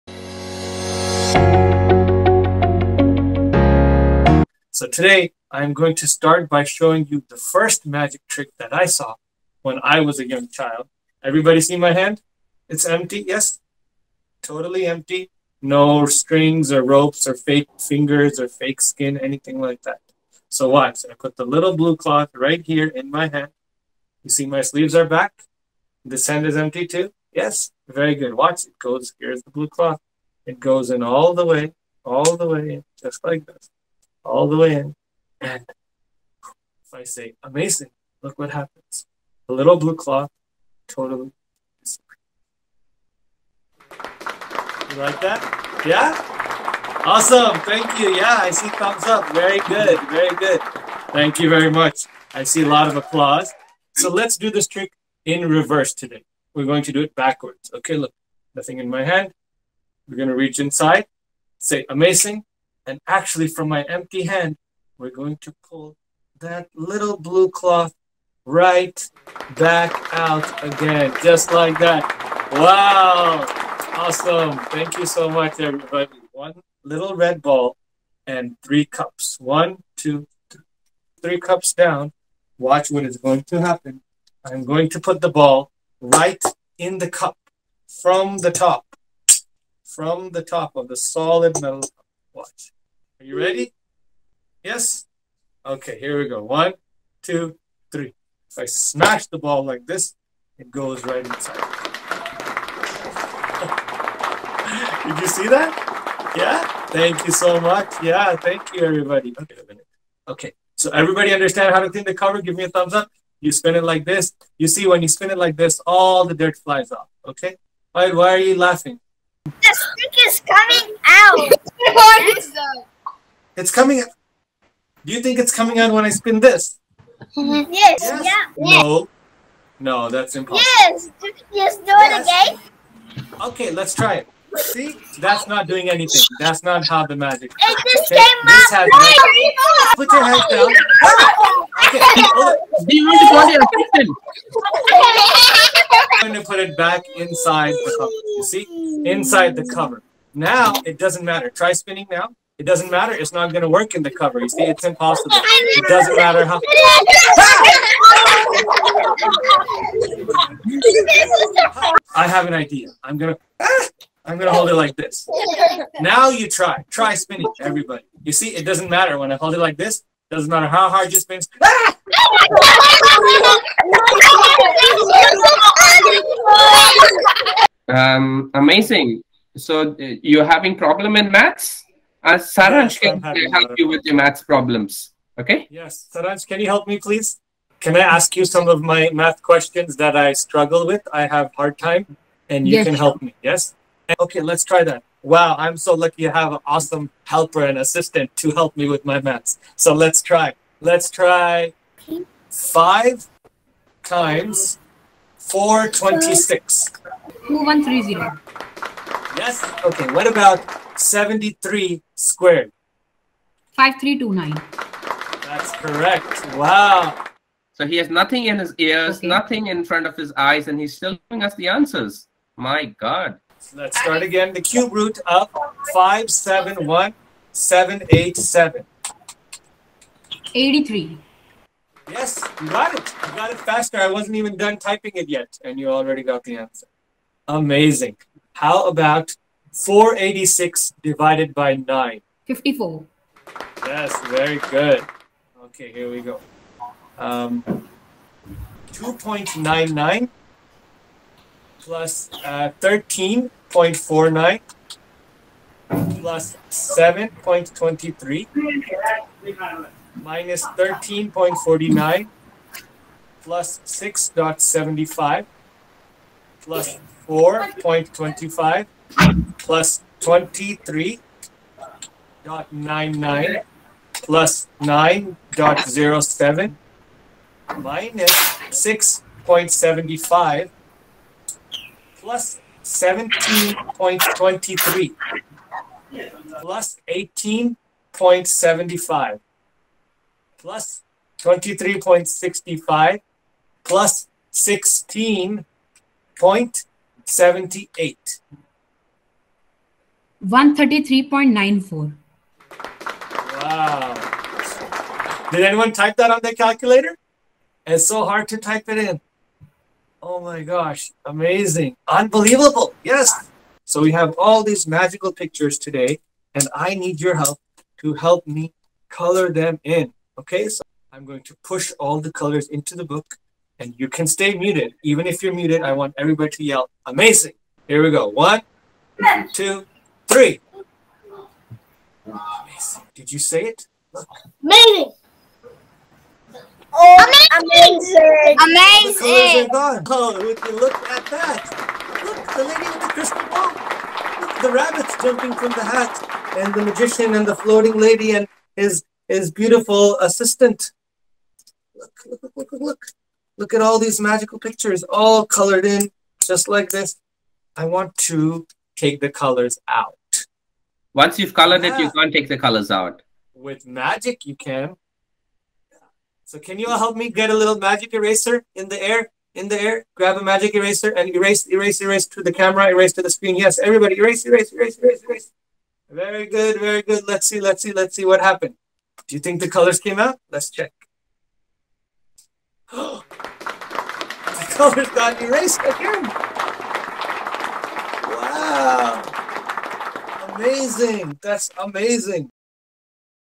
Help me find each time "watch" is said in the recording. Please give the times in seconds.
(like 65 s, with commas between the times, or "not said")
20 s, 28 s, 82 s, 92 s.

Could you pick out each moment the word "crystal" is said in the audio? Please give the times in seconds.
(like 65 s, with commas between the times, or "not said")
343 s.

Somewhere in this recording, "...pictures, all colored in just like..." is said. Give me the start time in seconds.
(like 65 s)
354 s.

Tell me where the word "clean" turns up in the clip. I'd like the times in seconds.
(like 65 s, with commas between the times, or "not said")
111 s.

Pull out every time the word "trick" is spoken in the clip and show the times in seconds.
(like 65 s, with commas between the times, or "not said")
8 s, 54 s.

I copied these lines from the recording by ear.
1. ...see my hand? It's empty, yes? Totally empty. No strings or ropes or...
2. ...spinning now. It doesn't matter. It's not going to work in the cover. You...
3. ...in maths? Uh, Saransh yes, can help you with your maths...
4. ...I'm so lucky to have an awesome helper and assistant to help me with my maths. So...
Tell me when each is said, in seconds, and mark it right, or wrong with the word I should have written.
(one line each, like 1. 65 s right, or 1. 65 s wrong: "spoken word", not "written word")
1. 11 s right
2. 151 s right
3. 181 s right
4. 195 s right.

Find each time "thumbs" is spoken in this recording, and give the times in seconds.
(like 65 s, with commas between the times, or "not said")
48 s, 112 s.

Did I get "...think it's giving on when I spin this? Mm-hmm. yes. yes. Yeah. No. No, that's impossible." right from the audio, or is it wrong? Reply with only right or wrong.
wrong.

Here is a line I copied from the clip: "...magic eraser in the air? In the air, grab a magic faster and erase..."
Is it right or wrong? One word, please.
wrong.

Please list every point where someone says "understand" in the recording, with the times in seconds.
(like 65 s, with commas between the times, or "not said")
111 s.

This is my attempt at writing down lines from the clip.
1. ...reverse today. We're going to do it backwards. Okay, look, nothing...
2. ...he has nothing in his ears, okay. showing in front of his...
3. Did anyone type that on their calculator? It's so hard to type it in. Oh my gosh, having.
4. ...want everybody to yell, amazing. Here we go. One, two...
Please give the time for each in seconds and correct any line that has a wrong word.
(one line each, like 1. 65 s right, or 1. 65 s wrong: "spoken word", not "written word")
1. 55 s right
2. 217 s wrong: "nothing", not "showing"
3. 305 s wrong: "amazing", not "having"
4. 325 s right.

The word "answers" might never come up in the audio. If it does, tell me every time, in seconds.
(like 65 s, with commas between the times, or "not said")
221 s, 236 s.